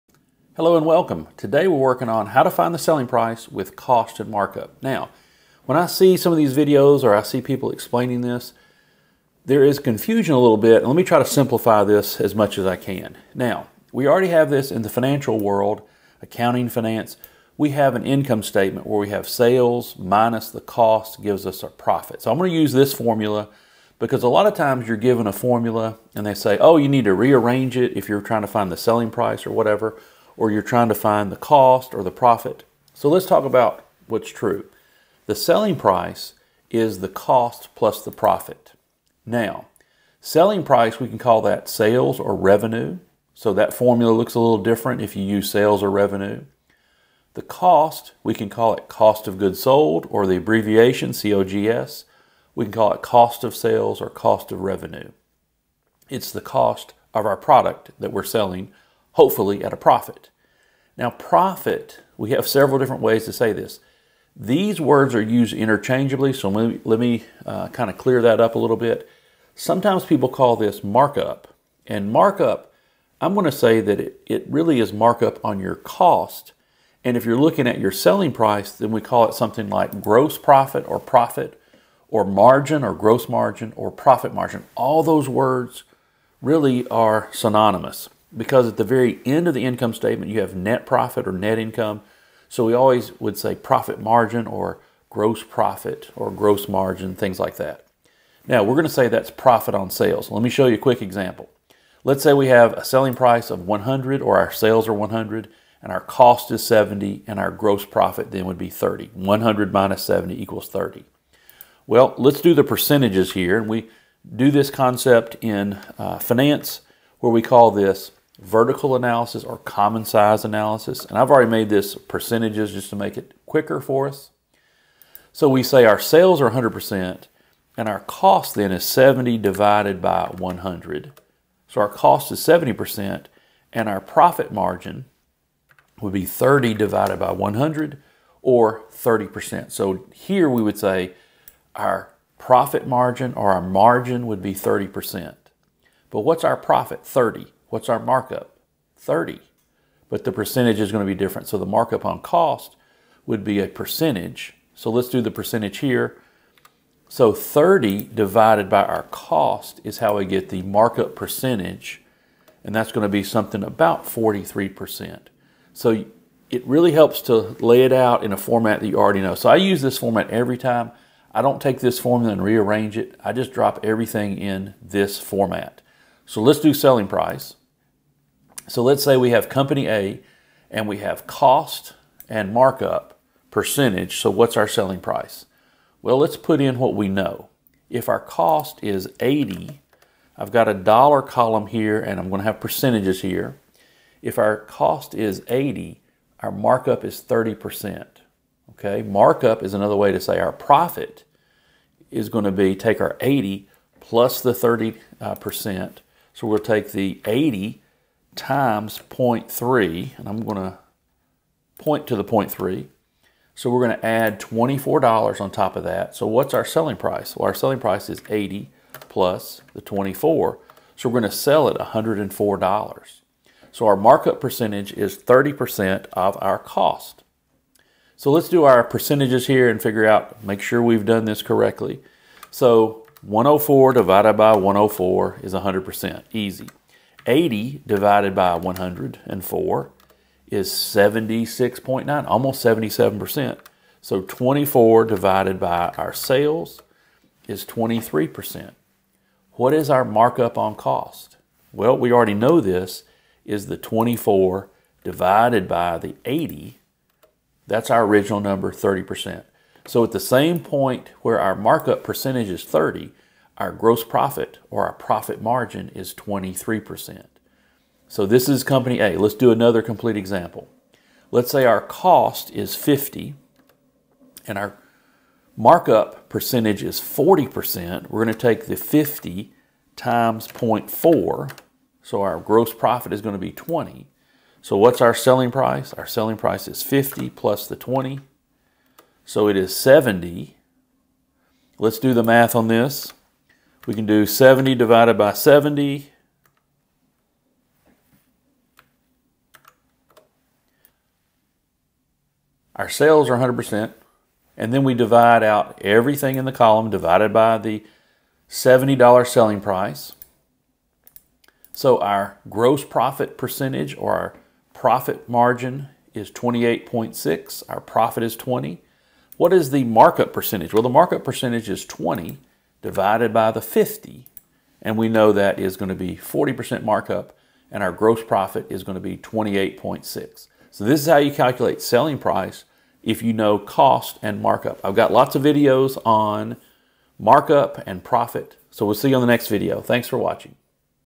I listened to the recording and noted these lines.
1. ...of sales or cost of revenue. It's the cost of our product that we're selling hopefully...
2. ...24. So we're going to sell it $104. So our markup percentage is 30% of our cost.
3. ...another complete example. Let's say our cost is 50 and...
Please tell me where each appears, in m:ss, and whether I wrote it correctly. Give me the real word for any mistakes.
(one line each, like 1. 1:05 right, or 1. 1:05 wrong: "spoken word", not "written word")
1. 0:53 right
2. 3:39 right
3. 4:29 right.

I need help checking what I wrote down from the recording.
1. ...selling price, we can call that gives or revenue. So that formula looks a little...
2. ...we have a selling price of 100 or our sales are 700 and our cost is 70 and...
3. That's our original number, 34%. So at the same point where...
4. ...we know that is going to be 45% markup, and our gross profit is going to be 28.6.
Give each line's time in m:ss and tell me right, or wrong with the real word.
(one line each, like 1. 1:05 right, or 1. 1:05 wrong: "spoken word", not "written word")
1. 0:40 wrong: "sales", not "gives"
2. 1:42 wrong: "100", not "700"
3. 4:17 wrong: "30", not "34"
4. 5:24 wrong: "40", not "45".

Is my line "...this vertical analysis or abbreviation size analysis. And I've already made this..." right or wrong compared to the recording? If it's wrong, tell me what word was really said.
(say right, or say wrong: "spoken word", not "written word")
wrong: "common", not "abbreviation".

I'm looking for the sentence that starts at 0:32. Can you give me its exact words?
So let's talk about what's true.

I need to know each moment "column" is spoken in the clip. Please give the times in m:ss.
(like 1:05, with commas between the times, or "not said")
3:11, 5:06.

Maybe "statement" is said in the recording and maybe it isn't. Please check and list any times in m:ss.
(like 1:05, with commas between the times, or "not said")
0:18, 1:29.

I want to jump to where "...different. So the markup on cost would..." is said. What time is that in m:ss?
2:31.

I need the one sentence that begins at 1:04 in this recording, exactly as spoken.
These words are used interchangeably, so let me, let me uh, kind of clear that up a little bit.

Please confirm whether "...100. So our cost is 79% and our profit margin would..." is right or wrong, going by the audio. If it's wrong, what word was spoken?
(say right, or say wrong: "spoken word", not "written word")
wrong: "70", not "79".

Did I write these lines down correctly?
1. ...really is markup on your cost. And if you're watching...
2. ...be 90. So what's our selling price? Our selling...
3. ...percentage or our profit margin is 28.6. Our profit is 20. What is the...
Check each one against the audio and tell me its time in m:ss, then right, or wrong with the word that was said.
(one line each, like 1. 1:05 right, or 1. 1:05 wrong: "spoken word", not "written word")
1. 1:14 wrong: "looking", not "watching"
2. 4:43 wrong: "20", not "90"
3. 5:13 right.